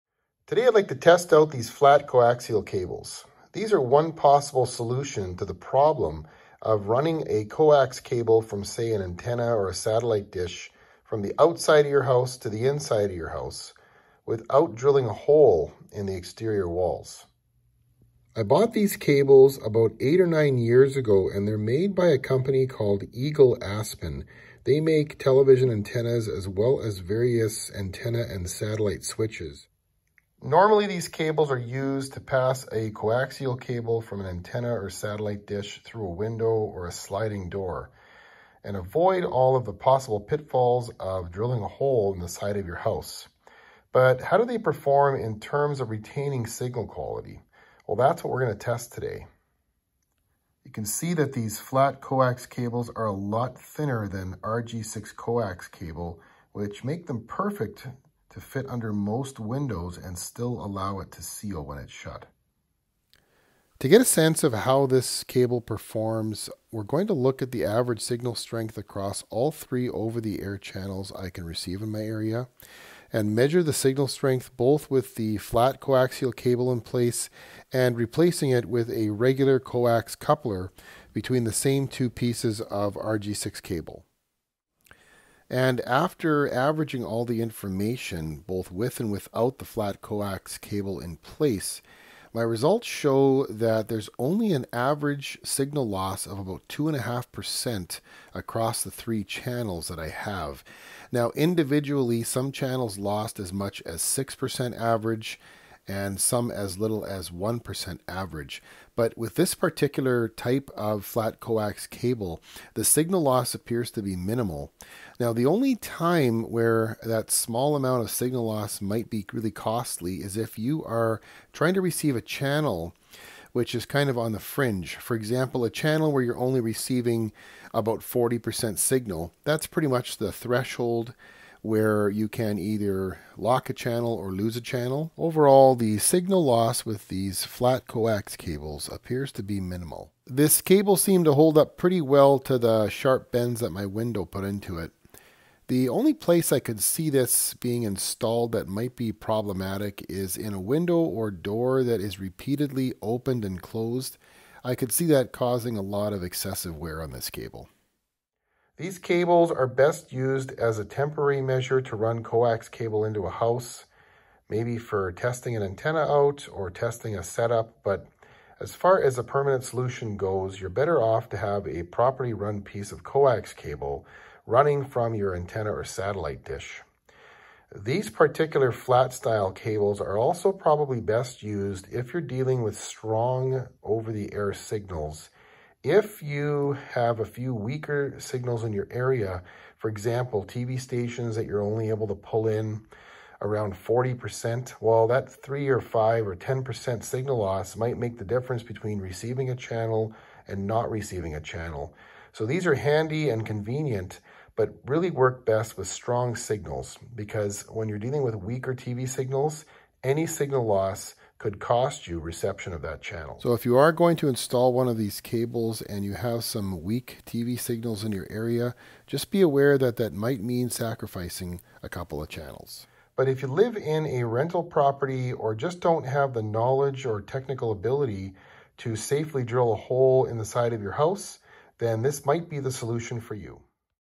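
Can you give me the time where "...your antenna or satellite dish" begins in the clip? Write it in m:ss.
2:55.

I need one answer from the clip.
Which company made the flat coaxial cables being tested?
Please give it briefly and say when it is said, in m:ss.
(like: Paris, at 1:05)
Eagle Aspen, at 0:23.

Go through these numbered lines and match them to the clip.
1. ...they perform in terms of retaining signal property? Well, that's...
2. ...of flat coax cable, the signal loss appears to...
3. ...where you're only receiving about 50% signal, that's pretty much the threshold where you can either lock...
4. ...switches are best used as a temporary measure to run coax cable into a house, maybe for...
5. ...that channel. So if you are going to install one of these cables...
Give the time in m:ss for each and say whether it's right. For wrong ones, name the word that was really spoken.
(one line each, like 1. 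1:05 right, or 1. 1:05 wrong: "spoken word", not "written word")
1. 0:44 wrong: "quality", not "property"
2. 1:50 right
3. 2:06 wrong: "40", not "50"
4. 2:38 wrong: "cables", not "switches"
5. 3:32 right.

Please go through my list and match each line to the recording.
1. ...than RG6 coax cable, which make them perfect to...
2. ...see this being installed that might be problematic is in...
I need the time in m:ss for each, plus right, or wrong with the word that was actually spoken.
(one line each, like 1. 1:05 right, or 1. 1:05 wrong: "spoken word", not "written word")
1. 0:54 right
2. 2:26 right.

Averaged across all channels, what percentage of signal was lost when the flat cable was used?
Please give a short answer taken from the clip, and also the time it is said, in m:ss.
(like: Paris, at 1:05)
2.5%, at 1:36.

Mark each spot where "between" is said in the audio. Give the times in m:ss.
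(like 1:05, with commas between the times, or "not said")
1:21, 3:18.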